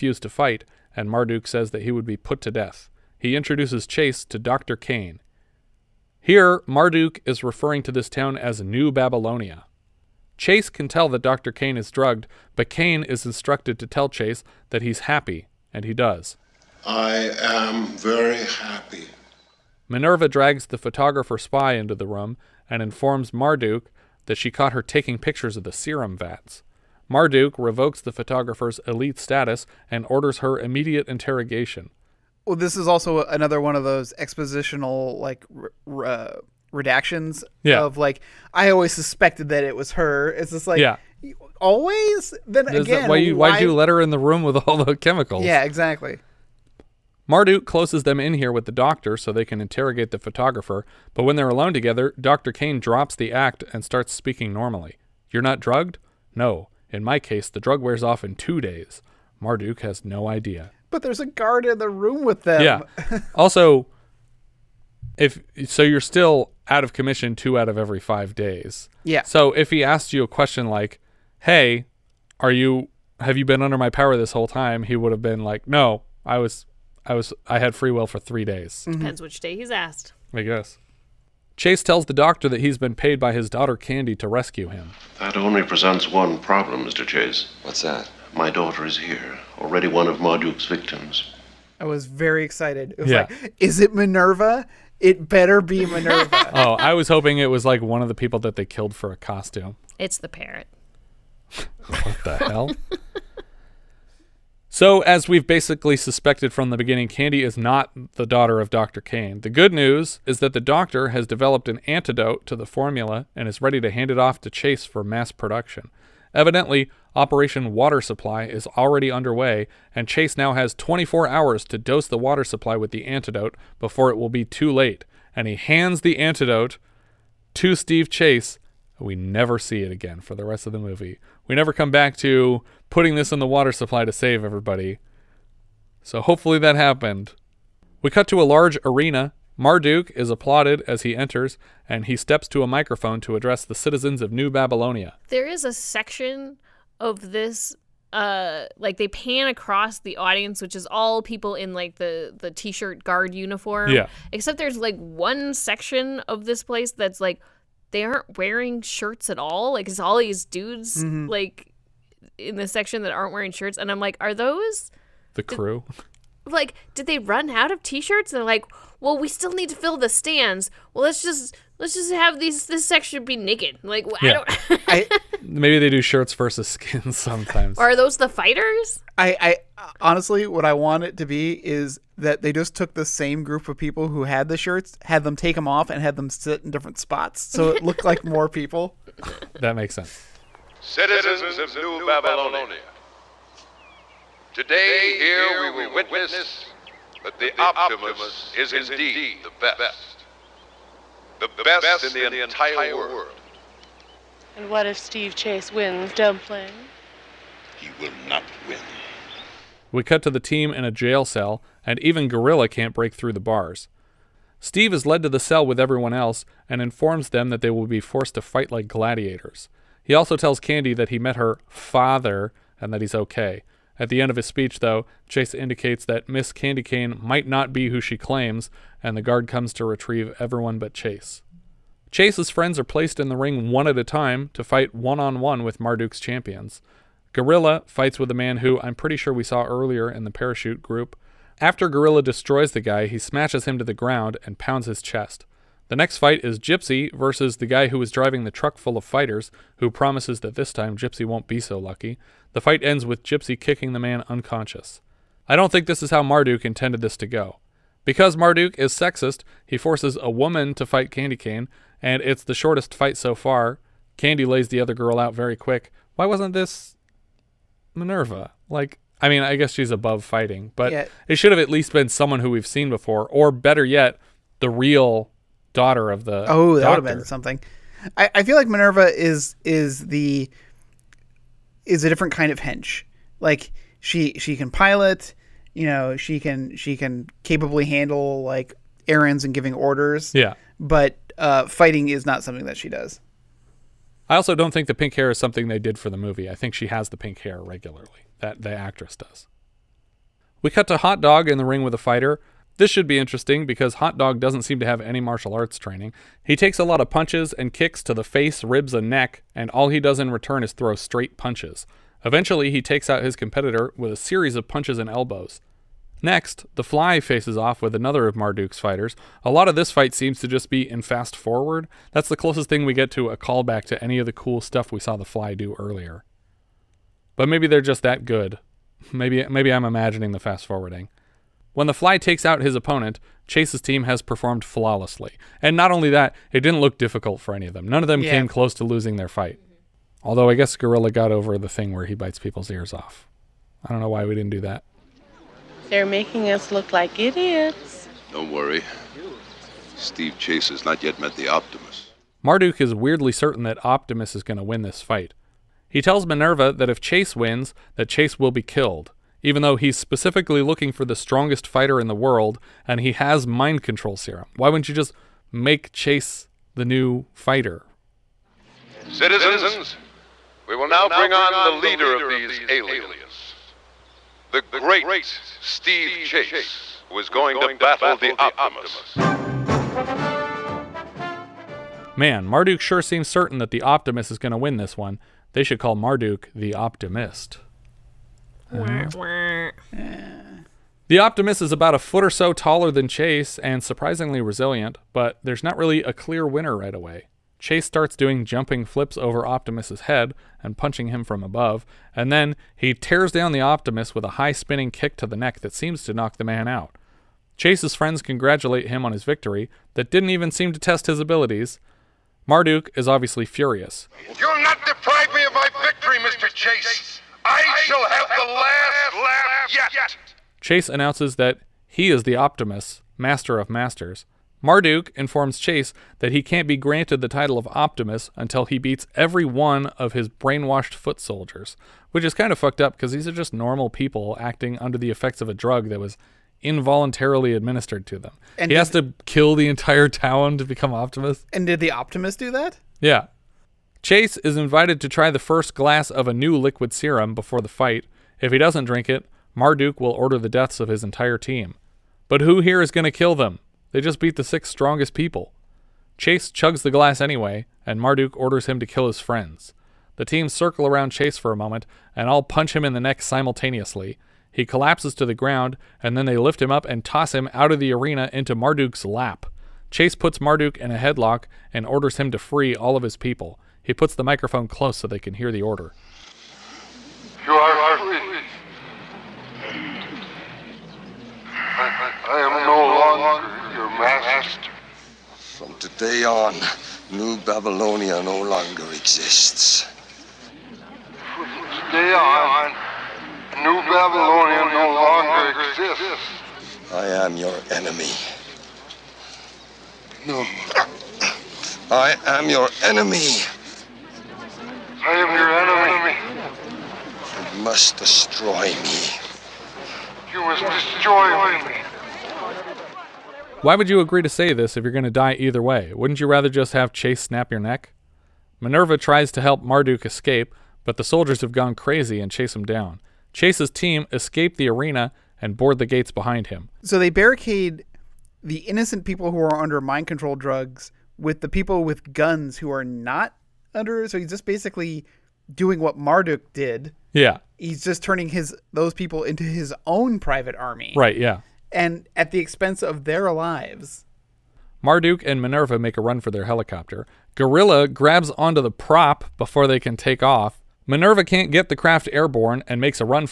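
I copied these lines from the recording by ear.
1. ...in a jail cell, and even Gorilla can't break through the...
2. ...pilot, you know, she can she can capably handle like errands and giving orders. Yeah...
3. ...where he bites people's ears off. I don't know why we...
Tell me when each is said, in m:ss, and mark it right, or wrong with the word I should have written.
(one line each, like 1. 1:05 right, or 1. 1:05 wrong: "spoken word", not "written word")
1. 3:30 right
2. 4:44 right
3. 5:41 right.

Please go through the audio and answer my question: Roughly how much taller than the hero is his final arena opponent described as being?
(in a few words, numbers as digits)
About a foot.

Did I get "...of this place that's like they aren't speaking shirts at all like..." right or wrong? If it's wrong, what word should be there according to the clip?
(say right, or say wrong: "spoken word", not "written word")
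wrong: "wearing", not "speaking".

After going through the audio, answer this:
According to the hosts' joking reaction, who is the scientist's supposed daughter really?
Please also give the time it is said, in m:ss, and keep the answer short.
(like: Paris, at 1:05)
The parrot, at 1:39.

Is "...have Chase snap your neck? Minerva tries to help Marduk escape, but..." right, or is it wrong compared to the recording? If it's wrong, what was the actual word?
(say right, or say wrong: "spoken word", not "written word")
right.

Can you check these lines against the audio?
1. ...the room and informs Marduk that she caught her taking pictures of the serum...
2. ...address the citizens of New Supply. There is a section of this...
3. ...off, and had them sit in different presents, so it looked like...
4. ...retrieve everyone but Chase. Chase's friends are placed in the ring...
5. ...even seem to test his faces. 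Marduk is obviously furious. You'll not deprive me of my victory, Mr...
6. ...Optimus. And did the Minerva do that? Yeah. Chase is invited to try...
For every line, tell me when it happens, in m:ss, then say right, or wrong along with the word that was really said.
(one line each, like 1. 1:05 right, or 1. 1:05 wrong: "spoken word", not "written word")
1. 0:21 right
2. 2:23 wrong: "Babylonia", not "Supply"
3. 3:05 wrong: "spots", not "presents"
4. 3:49 right
5. 6:50 wrong: "abilities", not "faces"
6. 7:20 wrong: "Optimus", not "Minerva".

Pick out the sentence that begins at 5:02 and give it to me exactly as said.
This should be interesting because Hot Dog doesn't seem to have any martial arts training.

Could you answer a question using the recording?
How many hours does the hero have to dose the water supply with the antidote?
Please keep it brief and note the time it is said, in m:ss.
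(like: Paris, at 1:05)
24, at 2:00.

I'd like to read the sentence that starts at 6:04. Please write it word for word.
Why wouldn't you just make Chase the new fighter?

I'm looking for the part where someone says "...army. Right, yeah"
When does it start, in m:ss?
9:00.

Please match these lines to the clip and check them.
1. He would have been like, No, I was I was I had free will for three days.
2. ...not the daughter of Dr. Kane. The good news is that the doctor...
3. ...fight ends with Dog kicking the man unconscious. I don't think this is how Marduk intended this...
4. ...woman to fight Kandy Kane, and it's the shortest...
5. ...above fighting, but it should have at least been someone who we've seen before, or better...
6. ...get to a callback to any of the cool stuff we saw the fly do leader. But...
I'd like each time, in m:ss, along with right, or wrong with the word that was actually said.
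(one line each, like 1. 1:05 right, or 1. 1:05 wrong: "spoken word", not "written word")
1. 1:14 right
2. 1:47 right
3. 4:12 wrong: "Gypsy", not "Dog"
4. 4:20 right
5. 4:29 right
6. 5:22 wrong: "earlier", not "leader".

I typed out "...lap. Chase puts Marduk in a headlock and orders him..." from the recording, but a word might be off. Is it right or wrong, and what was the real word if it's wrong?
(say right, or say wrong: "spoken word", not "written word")
right.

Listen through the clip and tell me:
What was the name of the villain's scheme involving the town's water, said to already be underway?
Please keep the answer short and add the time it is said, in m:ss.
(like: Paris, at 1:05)
Operation Water Supply, at 1:57.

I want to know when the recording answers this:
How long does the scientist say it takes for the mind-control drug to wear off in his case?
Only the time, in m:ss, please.
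0:58.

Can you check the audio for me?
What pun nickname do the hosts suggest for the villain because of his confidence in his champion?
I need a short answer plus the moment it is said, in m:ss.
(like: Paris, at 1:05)
The Optimist, at 6:26.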